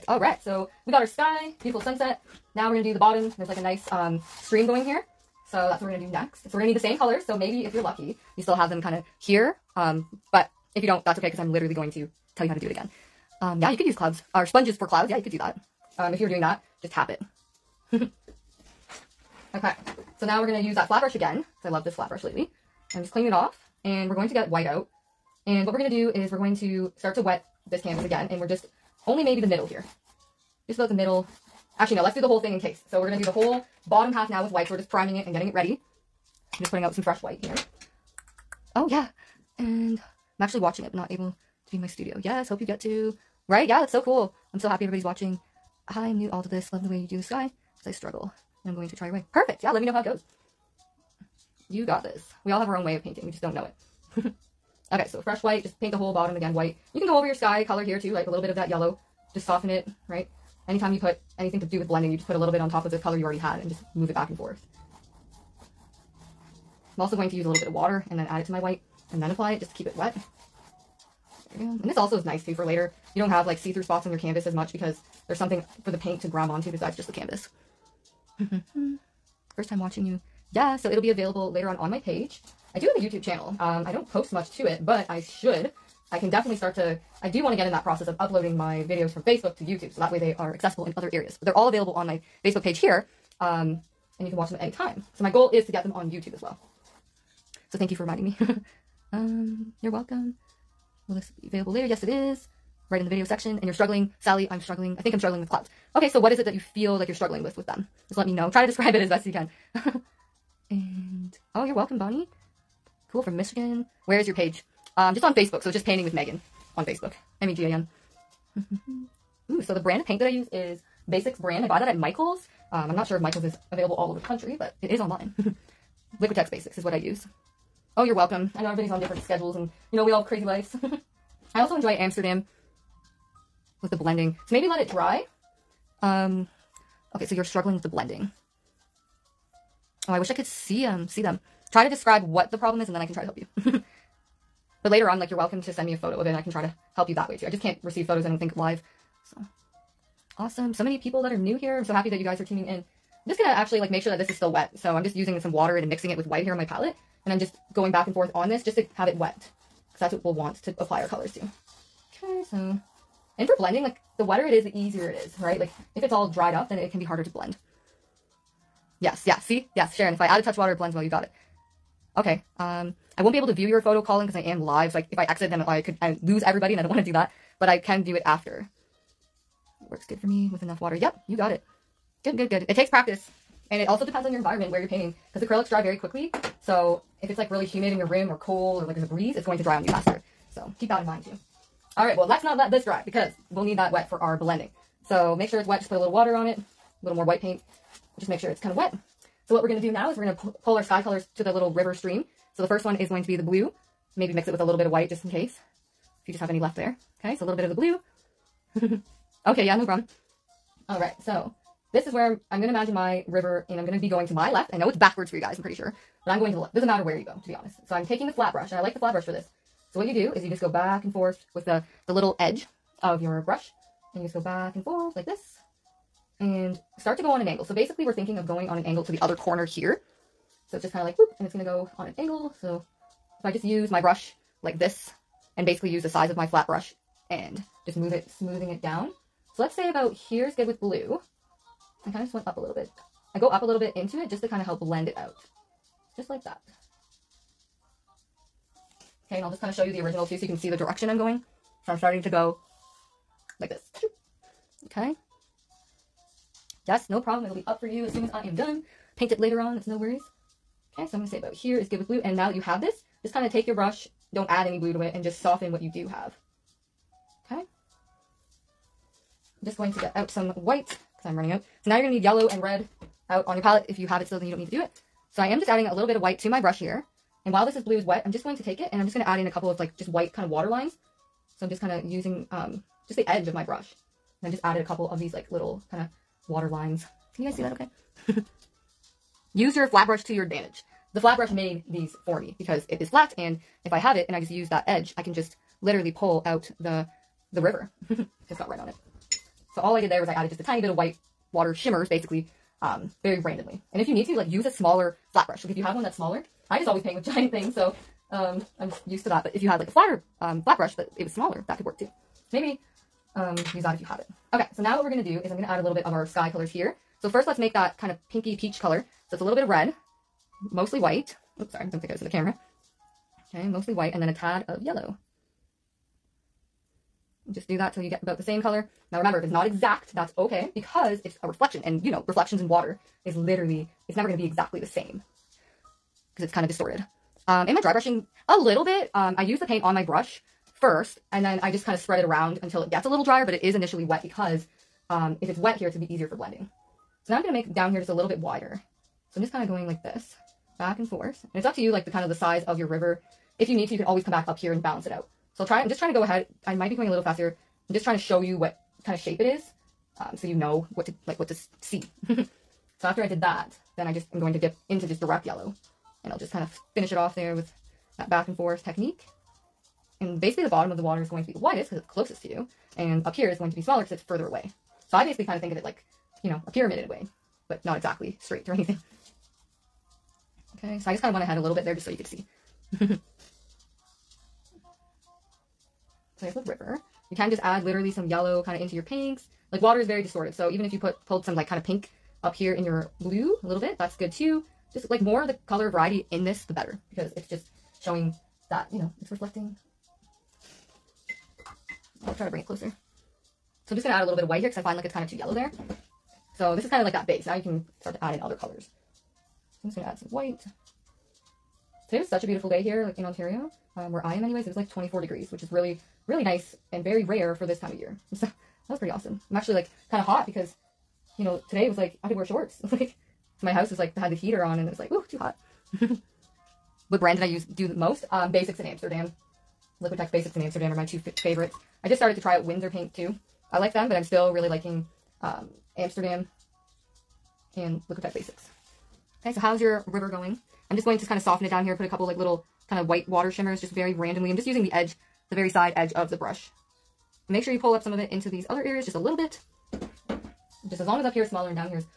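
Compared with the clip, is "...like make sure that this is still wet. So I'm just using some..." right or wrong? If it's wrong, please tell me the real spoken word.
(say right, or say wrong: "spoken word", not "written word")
right.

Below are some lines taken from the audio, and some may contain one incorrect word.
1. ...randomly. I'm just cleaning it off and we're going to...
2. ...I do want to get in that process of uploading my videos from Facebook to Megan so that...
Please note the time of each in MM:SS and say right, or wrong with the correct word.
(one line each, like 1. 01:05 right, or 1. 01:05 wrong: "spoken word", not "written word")
1. 00:22 wrong: "lately", not "randomly"
2. 01:27 wrong: "YouTube", not "Megan".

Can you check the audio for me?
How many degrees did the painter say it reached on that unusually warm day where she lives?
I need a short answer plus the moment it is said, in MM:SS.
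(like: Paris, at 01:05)
24, at 06:54.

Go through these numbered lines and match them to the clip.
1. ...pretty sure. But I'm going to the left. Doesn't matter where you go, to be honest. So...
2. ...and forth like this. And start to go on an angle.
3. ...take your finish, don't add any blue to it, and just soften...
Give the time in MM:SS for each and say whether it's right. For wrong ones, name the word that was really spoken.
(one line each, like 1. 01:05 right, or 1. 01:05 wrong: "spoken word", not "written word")
1. 03:35 right
2. 03:44 right
3. 04:23 wrong: "brush", not "finish".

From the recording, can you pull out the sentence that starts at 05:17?
So first let's make that kind of pinky peach color.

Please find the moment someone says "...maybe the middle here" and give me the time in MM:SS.
00:29.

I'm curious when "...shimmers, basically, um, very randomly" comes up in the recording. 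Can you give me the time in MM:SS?
05:01.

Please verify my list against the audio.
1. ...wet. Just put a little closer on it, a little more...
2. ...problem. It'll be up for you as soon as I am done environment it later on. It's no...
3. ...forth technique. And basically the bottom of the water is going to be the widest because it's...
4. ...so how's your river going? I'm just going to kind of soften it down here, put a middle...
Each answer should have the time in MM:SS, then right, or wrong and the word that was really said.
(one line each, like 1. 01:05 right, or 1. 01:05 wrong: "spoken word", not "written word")
1. 03:15 wrong: "water", not "closer"
2. 04:17 wrong: "paint", not "environment"
3. 06:08 right
4. 07:19 wrong: "couple", not "middle".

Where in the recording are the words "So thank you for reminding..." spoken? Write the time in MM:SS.
01:37.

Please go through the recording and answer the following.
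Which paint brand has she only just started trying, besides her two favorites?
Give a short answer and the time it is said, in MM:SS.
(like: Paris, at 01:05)
Winsor, at 07:12.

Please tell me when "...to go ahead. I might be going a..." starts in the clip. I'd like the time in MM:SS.
05:56.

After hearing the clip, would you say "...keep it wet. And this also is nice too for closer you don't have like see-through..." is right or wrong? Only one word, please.
wrong.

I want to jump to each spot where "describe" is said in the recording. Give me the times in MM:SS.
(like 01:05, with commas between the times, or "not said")
01:48, 02:21.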